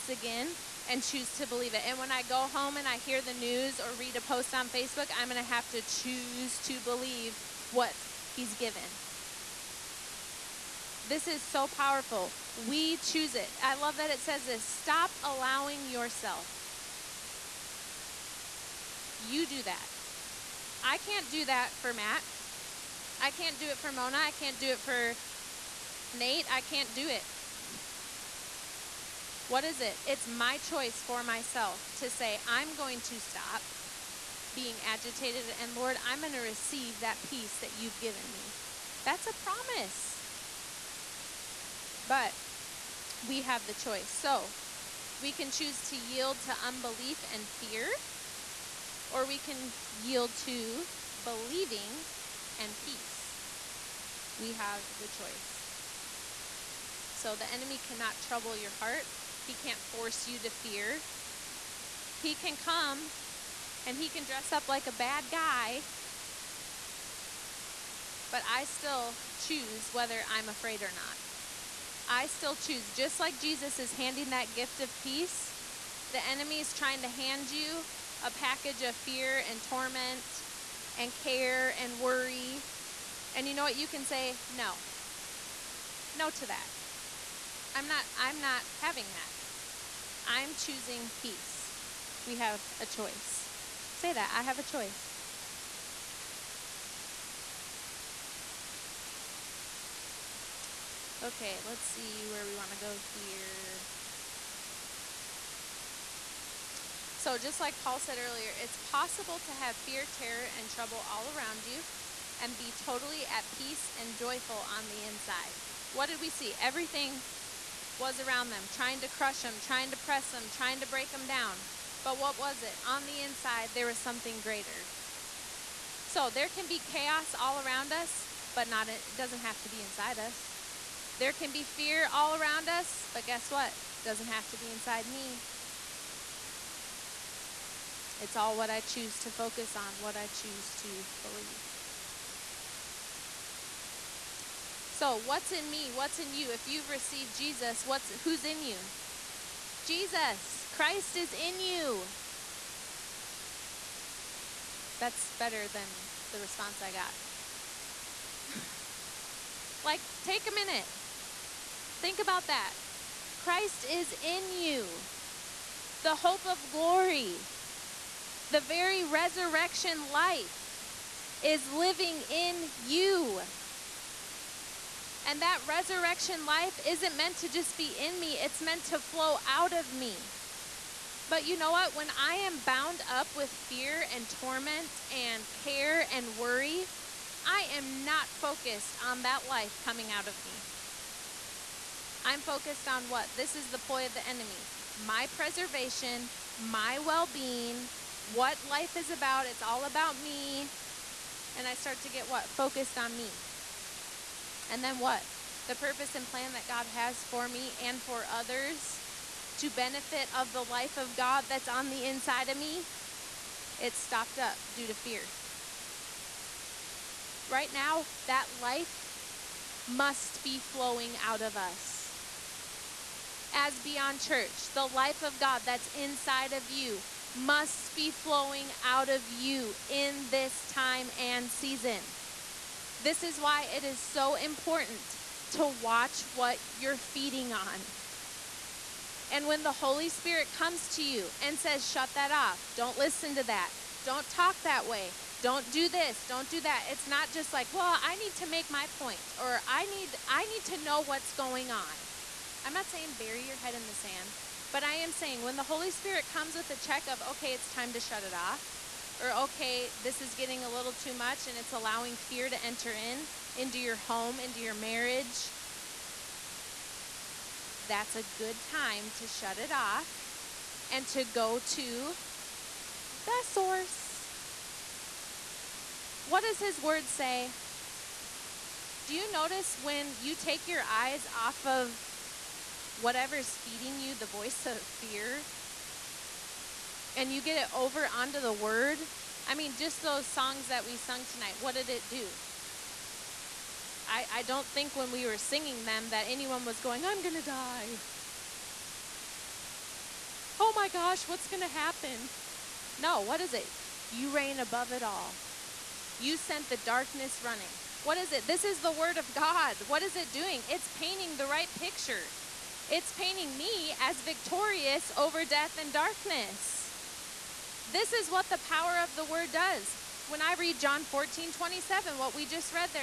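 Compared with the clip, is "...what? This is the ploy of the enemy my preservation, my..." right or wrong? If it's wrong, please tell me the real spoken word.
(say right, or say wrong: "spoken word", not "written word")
right.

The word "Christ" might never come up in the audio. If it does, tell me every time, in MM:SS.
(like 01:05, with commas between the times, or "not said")
02:30, 02:43.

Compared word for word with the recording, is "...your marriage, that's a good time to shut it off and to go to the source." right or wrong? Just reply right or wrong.
right.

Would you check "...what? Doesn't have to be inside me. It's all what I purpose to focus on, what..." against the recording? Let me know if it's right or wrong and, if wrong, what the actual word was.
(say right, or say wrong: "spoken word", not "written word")
wrong: "choose", not "purpose".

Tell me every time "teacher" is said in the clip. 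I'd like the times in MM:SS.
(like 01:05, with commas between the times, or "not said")
not said.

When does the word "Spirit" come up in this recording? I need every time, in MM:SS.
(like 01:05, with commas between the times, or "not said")
04:00, 04:15.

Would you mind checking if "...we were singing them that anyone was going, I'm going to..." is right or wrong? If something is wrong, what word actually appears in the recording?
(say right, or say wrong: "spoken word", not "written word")
right.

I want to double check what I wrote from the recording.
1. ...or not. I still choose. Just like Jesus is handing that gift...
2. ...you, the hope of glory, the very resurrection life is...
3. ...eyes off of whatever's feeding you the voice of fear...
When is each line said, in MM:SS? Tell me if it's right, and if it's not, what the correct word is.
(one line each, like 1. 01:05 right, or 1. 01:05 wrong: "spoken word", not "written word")
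1. 01:10 right
2. 02:44 right
3. 04:40 right.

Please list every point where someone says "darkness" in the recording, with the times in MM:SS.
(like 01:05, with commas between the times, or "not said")
05:06, 05:15.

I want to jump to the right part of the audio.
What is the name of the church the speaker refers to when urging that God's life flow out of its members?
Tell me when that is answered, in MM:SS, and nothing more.
03:43.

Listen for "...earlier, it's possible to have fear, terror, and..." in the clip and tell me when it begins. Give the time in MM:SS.
01:48.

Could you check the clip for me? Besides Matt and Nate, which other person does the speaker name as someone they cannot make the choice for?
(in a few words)
Mona.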